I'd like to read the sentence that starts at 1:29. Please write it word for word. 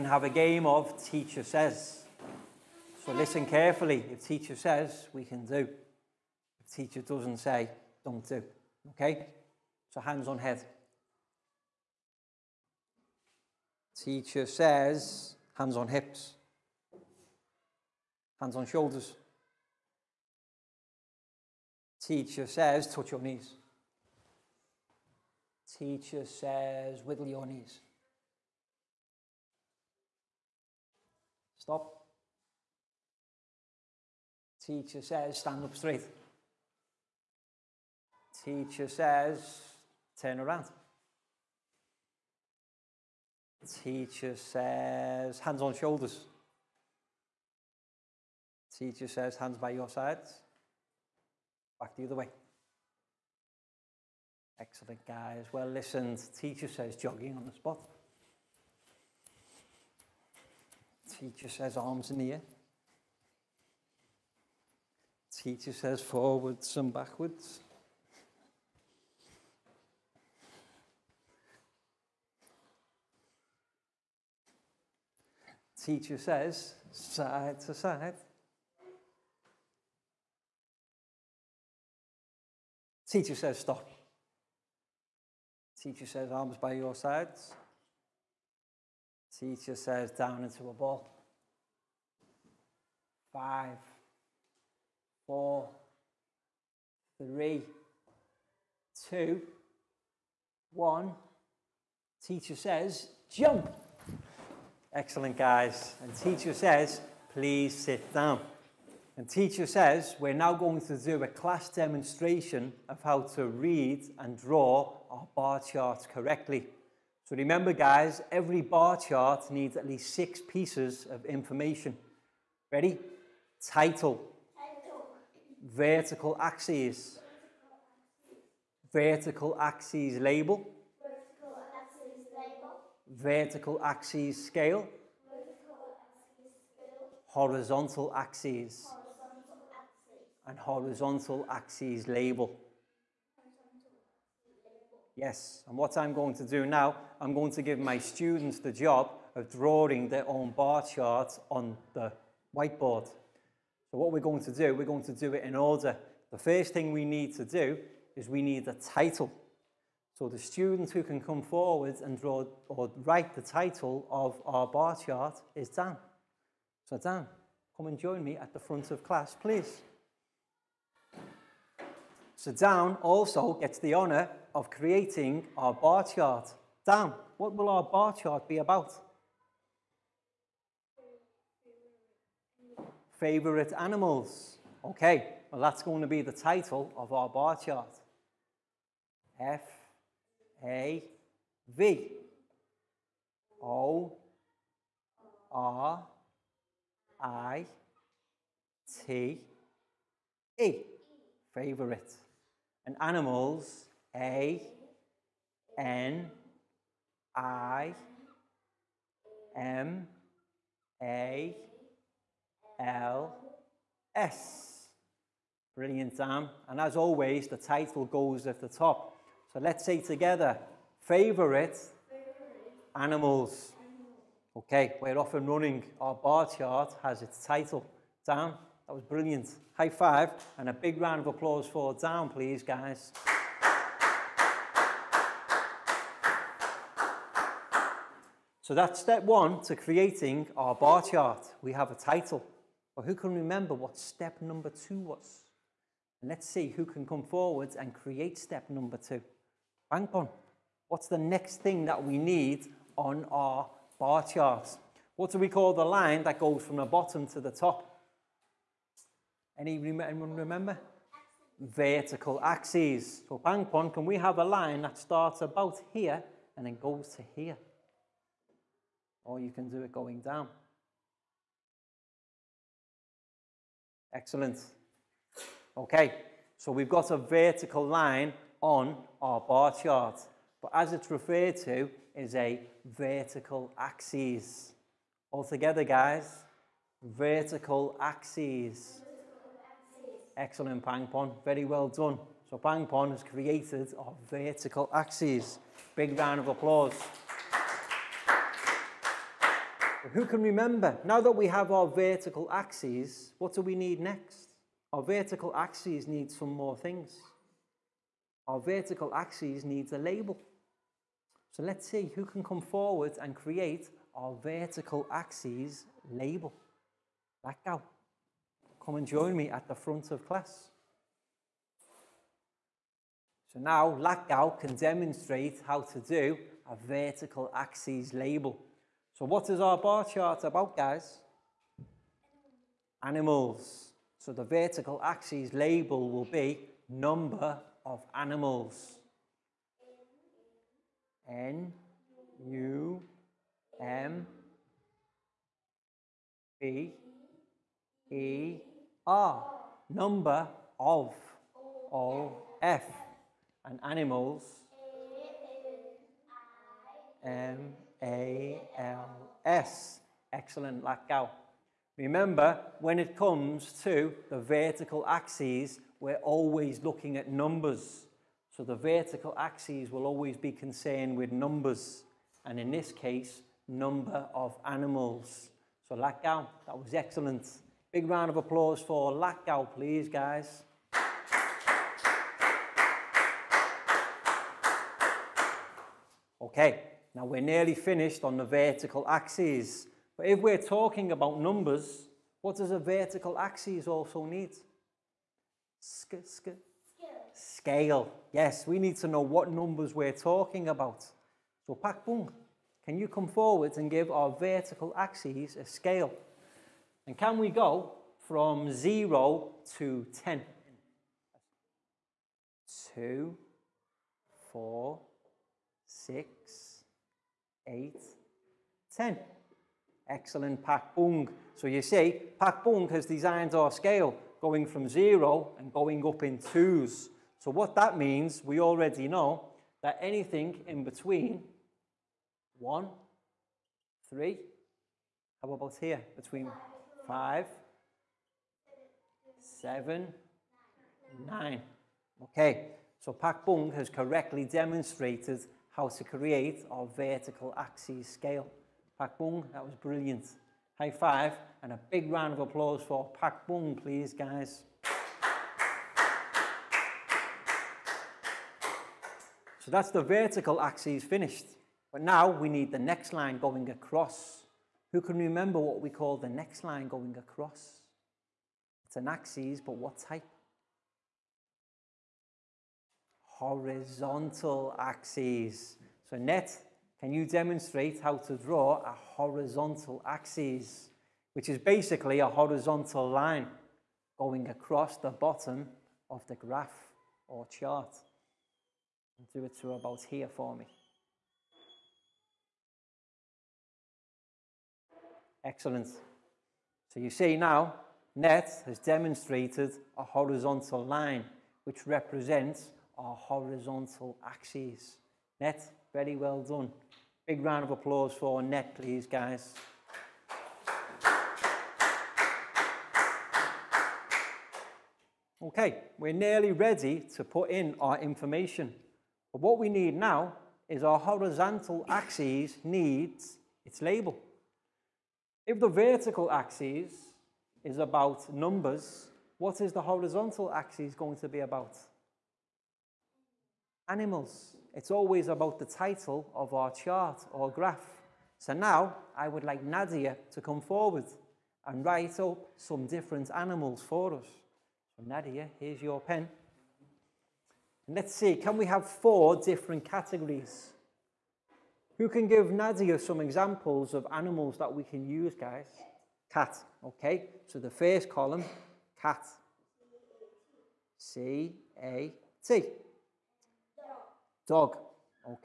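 Teacher says down into a ball.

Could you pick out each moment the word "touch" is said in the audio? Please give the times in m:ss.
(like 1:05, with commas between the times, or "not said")
0:22.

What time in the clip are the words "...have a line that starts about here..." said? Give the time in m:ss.
4:24.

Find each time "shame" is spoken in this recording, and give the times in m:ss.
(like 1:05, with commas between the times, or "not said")
not said.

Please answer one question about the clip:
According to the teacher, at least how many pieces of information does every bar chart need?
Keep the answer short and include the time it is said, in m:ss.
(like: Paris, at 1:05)
6, at 2:00.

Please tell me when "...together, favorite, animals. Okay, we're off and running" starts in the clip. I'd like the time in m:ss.
3:40.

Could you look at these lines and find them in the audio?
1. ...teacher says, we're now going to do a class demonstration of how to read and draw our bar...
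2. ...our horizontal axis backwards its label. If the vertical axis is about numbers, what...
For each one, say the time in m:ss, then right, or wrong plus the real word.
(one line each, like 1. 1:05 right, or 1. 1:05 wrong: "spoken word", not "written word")
1. 1:49 right
2. 8:40 wrong: "needs", not "backwards".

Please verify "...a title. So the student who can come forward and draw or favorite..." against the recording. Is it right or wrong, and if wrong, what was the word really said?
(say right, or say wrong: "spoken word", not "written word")
wrong: "write", not "favorite".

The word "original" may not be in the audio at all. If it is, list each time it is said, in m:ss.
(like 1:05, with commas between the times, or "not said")
not said.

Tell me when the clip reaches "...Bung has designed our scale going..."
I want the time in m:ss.
7:02.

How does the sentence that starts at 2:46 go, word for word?
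So Dan, come and join me at the front of class, please.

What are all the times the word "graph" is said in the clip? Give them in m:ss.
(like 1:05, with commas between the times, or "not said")
8:06, 8:57.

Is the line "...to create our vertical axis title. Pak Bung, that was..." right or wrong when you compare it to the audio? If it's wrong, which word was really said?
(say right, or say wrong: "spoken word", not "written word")
wrong: "scale", not "title".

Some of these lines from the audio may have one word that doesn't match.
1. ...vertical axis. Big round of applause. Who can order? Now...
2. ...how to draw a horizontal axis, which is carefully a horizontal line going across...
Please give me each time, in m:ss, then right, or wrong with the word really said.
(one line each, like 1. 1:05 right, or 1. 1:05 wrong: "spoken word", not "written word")
1. 4:54 wrong: "remember", not "order"
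2. 7:58 wrong: "basically", not "carefully".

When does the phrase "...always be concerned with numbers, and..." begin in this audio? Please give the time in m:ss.
6:10.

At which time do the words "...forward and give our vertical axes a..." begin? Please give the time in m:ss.
6:43.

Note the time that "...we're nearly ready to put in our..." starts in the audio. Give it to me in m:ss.
8:35.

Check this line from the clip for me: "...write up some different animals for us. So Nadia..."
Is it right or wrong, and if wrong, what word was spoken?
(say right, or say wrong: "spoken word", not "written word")
right.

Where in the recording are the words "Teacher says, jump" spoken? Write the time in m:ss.
1:42.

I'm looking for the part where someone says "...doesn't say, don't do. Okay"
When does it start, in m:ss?
0:07.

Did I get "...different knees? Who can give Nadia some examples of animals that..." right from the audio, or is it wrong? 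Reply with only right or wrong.
wrong.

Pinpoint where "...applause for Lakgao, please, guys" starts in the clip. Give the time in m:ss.
6:18.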